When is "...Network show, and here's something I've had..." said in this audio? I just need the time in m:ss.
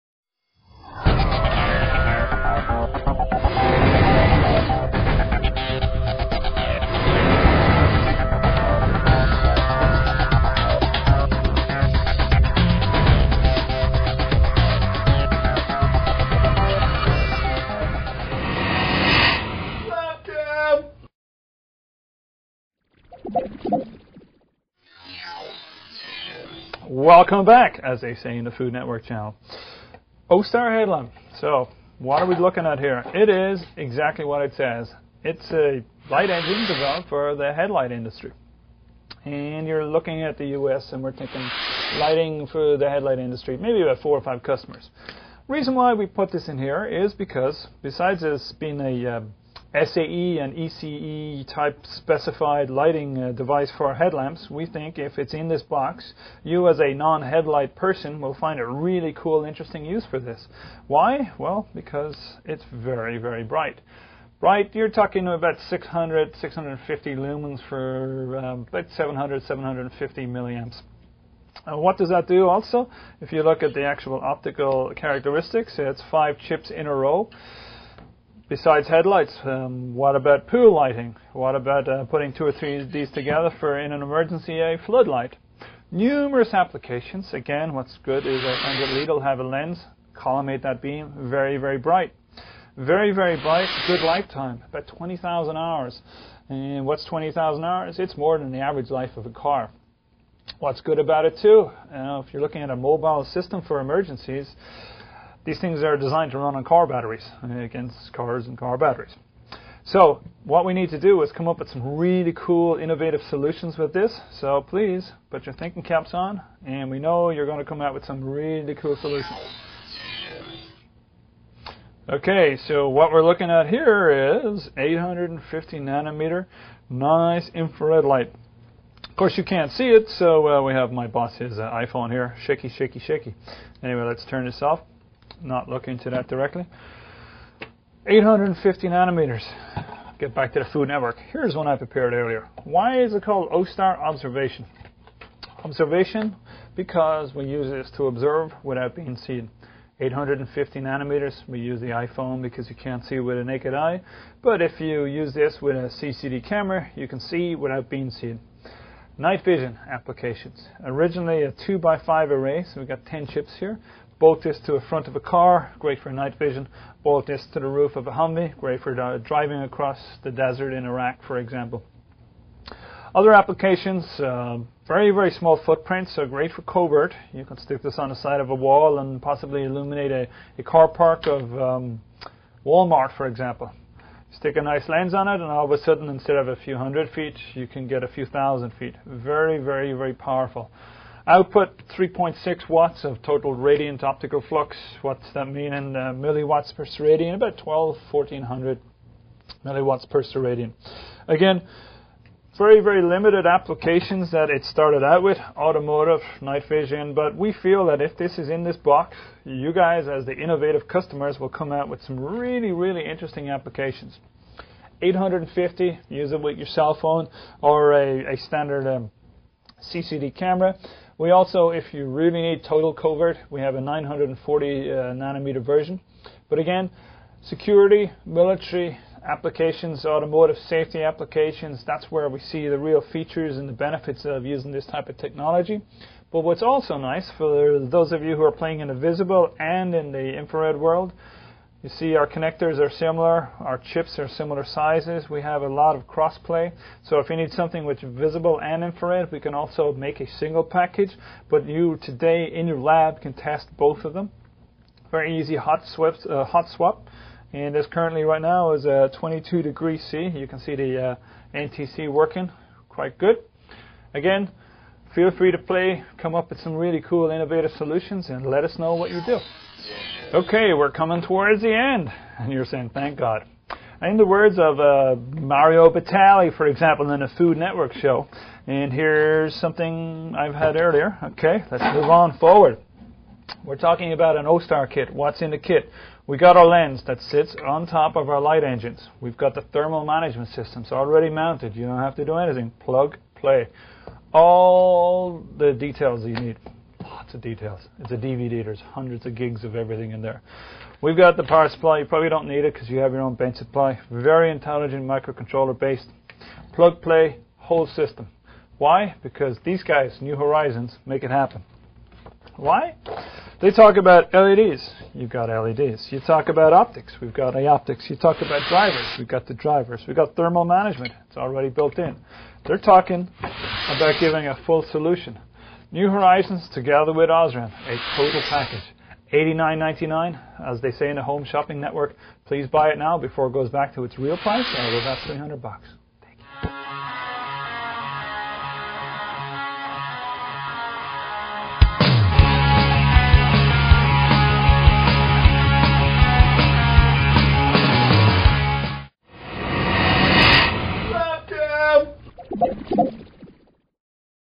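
4:37.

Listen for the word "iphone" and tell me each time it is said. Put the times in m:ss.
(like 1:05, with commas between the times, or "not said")
2:11, 2:31.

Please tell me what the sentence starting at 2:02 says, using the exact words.
Okay, so what we're looking at here is 850 nanometer nice infrared light.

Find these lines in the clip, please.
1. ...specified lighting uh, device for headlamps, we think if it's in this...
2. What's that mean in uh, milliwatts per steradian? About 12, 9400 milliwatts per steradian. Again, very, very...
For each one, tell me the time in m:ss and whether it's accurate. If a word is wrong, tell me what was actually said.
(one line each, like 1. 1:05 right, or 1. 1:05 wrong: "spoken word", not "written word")
1. 0:51 right
2. 3:15 wrong: "1400", not "9400".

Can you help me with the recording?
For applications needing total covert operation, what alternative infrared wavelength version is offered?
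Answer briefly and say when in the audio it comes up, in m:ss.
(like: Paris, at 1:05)
940 nanometers, at 3:43.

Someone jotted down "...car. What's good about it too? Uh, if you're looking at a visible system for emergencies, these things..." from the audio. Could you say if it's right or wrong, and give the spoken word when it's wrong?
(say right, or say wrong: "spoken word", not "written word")
wrong: "mobile", not "visible".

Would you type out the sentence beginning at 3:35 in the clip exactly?
850, use it with your cell phone or a, a standard um, CCD camera.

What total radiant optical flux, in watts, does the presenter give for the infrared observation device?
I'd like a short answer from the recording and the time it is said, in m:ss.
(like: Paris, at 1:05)
3.6 watts, at 3:11.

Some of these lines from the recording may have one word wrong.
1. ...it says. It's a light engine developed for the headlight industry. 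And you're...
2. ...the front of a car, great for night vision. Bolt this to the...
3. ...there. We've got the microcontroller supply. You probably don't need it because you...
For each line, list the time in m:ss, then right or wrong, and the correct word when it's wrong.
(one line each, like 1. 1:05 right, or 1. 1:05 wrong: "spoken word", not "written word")
1. 0:34 right
2. 2:44 right
3. 5:00 wrong: "power", not "microcontroller".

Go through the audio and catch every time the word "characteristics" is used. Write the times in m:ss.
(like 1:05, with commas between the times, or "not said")
1:14.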